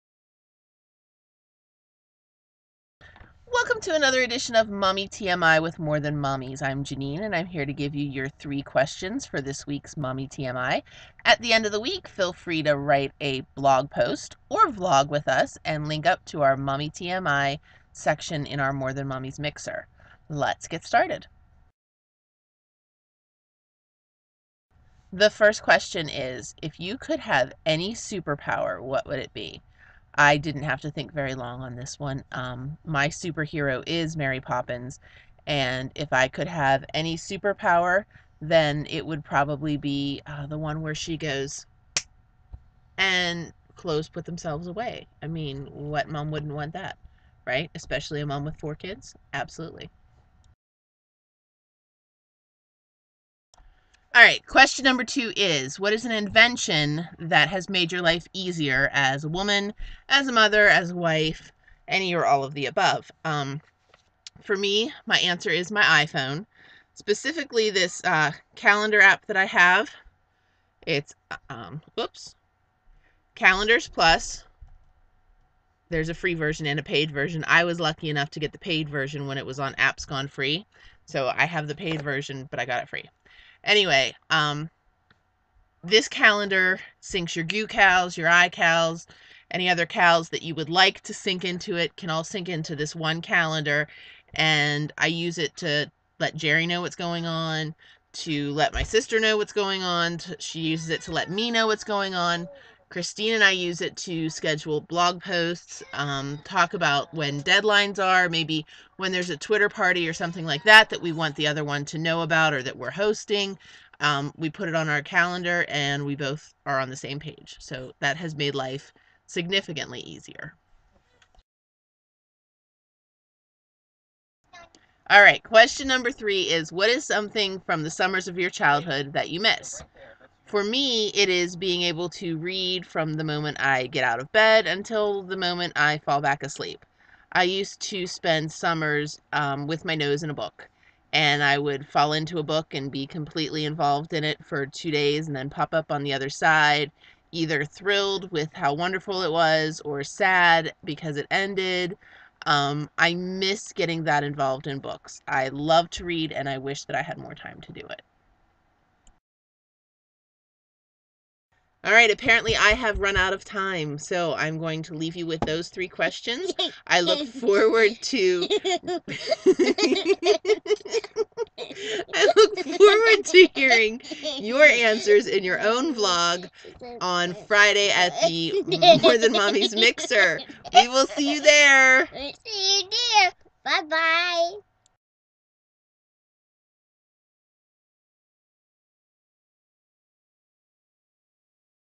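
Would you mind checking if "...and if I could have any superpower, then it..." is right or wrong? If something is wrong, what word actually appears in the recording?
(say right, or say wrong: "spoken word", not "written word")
right.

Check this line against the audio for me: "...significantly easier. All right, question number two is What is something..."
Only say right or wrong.
wrong.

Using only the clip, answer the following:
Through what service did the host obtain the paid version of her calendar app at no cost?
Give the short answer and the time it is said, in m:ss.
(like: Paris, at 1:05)
Apps Gone Free, at 1:19.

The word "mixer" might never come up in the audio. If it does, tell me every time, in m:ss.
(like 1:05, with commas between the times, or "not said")
0:19, 2:59.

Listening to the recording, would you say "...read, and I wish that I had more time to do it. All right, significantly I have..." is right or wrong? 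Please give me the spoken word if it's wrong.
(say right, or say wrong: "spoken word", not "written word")
wrong: "apparently", not "significantly".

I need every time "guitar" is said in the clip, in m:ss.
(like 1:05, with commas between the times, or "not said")
not said.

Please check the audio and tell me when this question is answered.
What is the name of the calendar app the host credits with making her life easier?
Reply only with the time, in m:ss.
1:13.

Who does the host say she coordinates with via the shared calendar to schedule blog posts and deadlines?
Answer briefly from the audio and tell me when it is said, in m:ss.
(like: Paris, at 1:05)
Christine, at 1:42.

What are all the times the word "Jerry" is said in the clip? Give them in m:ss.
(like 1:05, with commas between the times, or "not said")
1:36.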